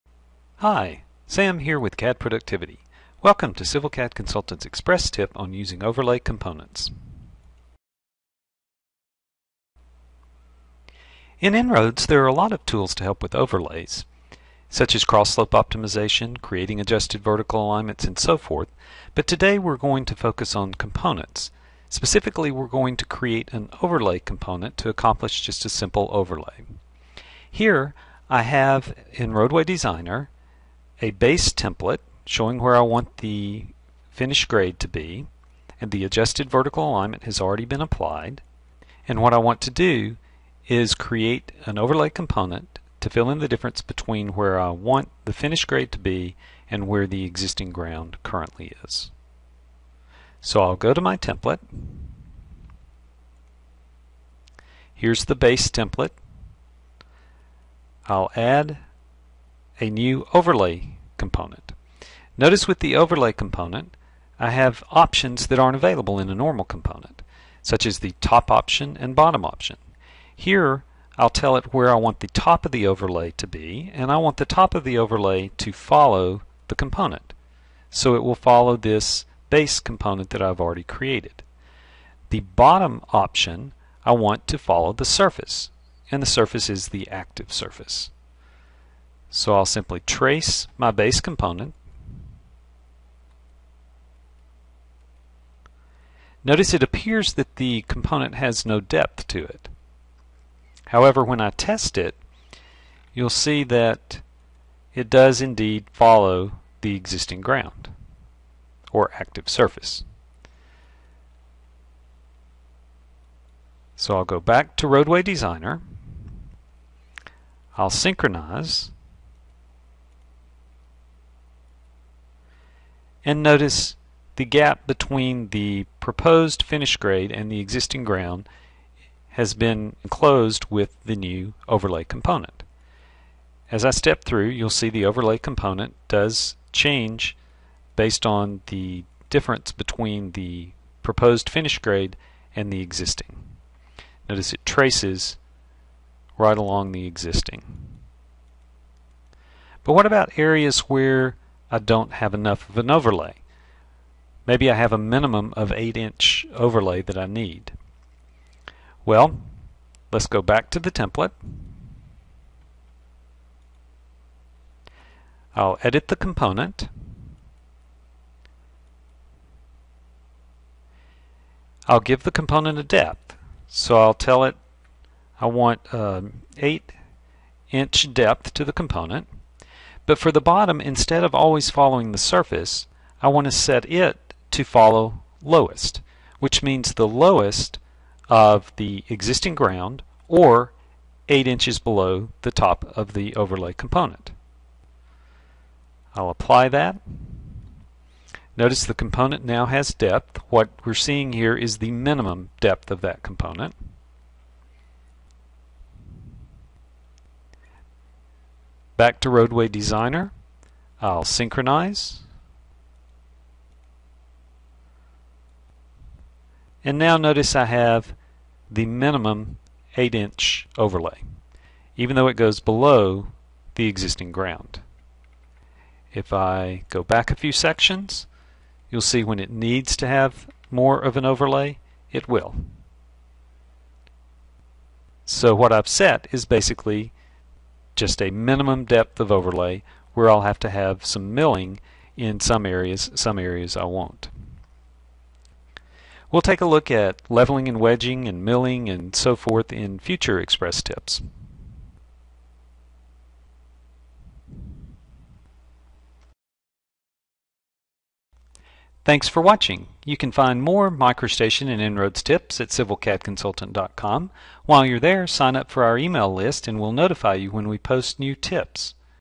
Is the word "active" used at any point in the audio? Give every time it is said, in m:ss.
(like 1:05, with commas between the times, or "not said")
1:27, 1:49.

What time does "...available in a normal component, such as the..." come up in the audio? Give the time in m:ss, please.
1:05.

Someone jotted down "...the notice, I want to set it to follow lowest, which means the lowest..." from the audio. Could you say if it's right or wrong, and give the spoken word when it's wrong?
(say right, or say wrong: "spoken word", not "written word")
wrong: "surface", not "notice".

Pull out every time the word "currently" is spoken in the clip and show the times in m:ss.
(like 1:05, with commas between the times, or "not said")
0:48.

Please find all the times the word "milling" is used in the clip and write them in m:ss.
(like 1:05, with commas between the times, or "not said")
4:01, 4:08.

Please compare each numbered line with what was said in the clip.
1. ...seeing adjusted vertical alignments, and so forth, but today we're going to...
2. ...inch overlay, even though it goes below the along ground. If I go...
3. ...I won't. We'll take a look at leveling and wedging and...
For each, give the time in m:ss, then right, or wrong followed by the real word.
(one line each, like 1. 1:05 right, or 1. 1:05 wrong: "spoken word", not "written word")
1. 0:16 wrong: "creating", not "seeing"
2. 3:40 wrong: "existing", not "along"
3. 4:03 right.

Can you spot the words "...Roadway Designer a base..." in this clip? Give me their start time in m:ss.
0:29.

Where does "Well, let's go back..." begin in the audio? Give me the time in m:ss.
2:39.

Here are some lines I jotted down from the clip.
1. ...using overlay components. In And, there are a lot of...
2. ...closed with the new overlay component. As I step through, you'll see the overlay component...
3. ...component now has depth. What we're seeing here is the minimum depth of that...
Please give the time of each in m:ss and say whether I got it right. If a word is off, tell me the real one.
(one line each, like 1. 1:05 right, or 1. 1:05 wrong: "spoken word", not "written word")
1. 0:05 wrong: "InRoads", not "And"
2. 2:10 right
3. 3:18 right.